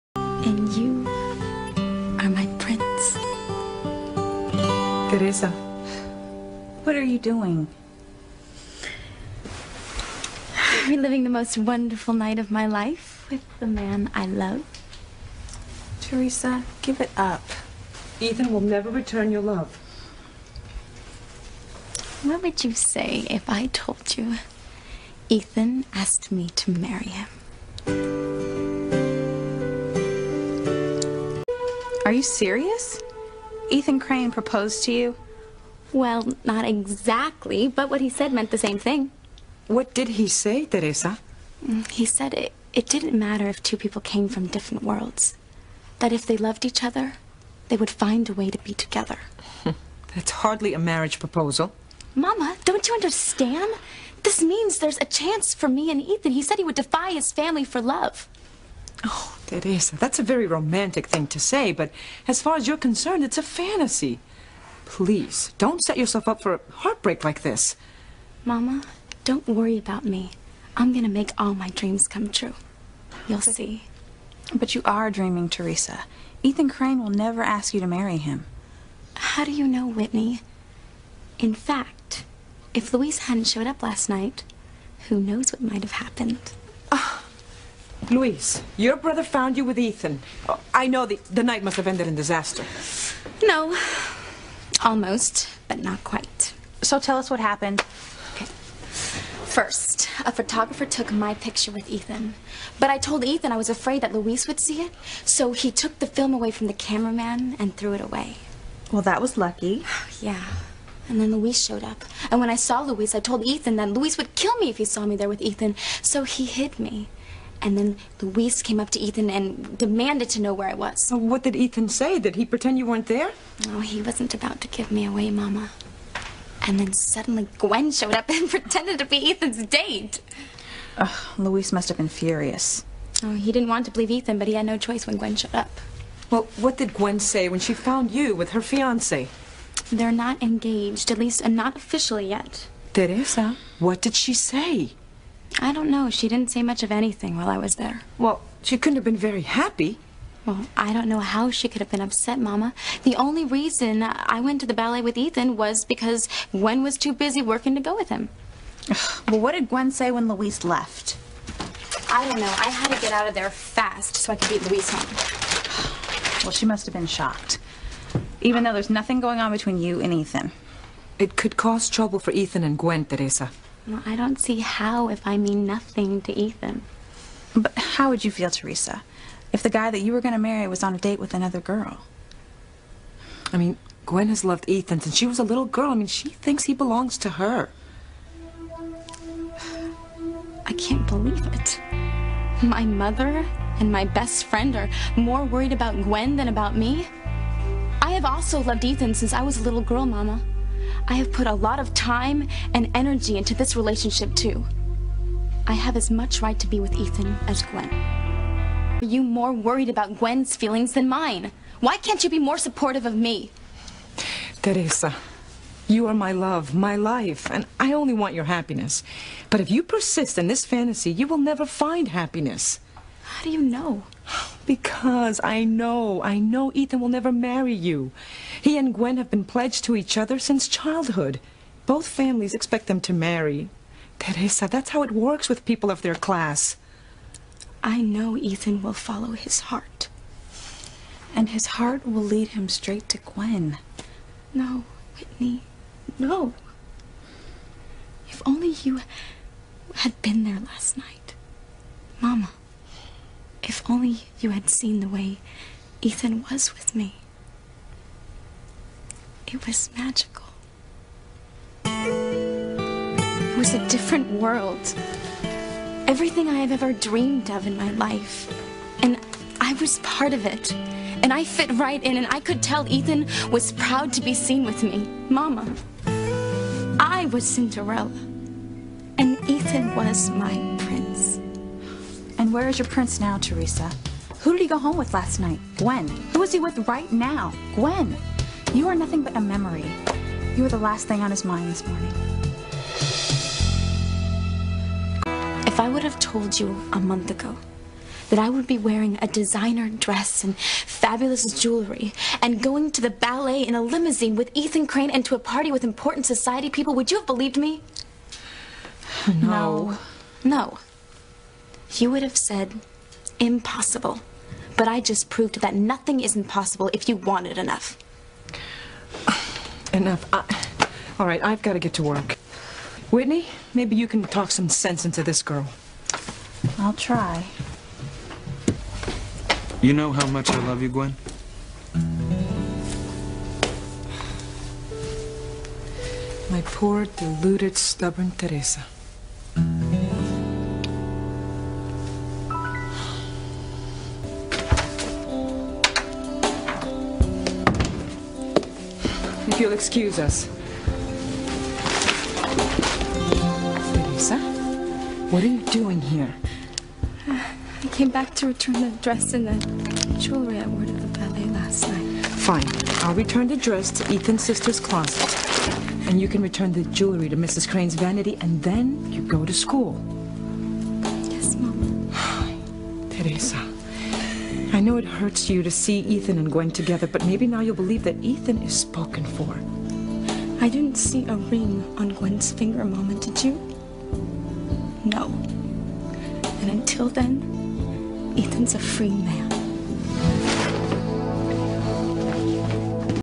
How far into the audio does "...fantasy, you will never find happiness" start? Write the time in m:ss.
3:40.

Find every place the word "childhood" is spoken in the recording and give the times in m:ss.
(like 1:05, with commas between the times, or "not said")
3:50.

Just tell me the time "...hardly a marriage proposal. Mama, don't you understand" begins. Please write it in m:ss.
0:50.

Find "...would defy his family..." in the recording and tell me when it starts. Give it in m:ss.
0:56.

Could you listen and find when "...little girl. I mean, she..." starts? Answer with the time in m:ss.
3:05.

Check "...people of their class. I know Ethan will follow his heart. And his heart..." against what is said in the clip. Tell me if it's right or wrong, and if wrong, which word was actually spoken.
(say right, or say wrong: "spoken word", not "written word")
right.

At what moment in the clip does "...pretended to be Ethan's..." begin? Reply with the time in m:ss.
2:08.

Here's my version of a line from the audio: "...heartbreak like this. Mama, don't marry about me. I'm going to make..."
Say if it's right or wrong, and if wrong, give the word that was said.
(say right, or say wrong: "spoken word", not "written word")
wrong: "worry", not "marry".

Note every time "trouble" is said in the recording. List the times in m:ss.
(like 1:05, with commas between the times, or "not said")
2:51.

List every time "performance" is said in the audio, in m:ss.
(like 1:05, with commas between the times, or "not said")
not said.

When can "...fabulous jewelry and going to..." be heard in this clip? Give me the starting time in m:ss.
5:00.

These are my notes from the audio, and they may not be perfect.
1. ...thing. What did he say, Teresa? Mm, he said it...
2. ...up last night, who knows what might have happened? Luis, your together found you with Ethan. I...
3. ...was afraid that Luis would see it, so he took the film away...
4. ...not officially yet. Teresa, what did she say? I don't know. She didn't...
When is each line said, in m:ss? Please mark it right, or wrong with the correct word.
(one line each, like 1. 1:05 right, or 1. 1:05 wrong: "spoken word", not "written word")
1. 0:38 right
2. 1:23 wrong: "brother", not "together"
3. 1:43 right
4. 2:21 right.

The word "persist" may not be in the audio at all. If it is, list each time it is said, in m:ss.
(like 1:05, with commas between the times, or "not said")
3:39.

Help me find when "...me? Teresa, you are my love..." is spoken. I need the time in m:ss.
3:33.